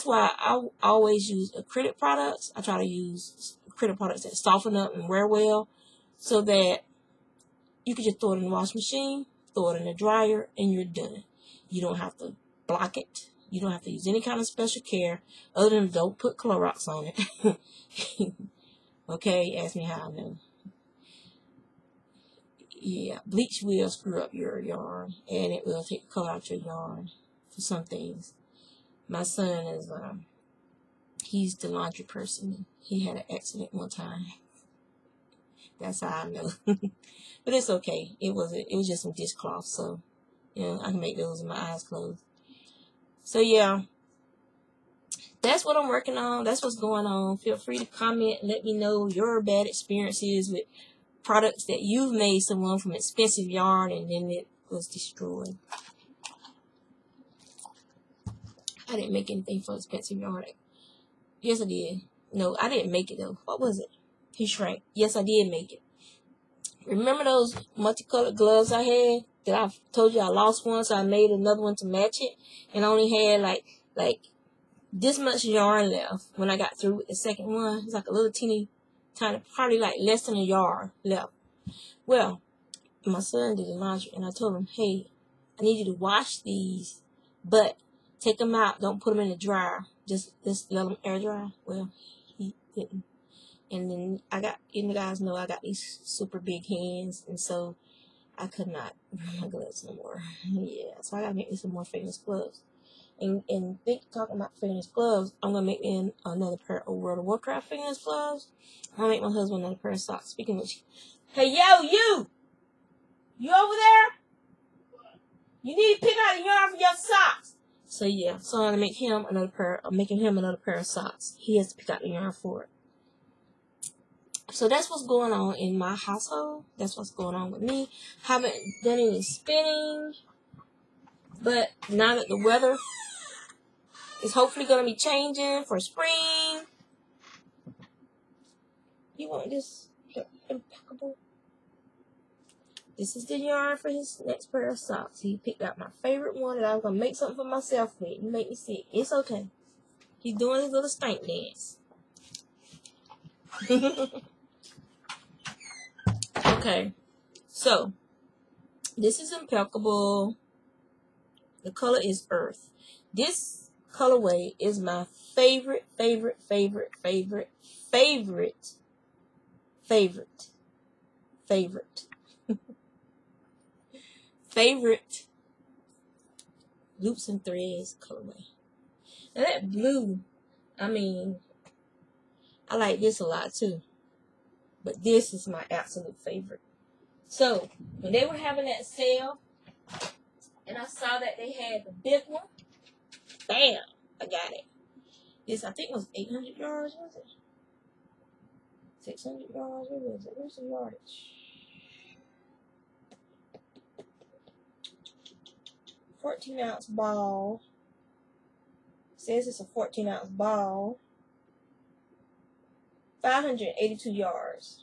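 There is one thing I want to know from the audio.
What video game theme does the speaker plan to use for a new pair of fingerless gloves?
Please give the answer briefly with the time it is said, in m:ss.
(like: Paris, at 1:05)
World of Warcraft, at 1:46.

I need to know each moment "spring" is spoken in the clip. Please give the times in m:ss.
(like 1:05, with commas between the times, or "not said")
2:15.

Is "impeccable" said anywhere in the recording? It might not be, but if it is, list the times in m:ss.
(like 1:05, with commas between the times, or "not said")
2:20, 2:39.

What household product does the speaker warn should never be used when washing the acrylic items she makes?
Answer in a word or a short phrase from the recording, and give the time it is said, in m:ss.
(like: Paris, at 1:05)
Clorox, at 0:16.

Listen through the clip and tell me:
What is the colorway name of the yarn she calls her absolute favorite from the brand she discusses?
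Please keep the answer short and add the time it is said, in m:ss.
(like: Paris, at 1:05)
Earth, at 2:42.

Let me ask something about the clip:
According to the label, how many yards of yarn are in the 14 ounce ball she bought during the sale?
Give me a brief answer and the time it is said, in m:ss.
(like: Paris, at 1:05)
582, at 3:33.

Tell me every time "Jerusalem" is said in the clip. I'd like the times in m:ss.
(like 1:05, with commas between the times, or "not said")
not said.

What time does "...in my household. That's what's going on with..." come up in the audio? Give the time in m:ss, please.
2:05.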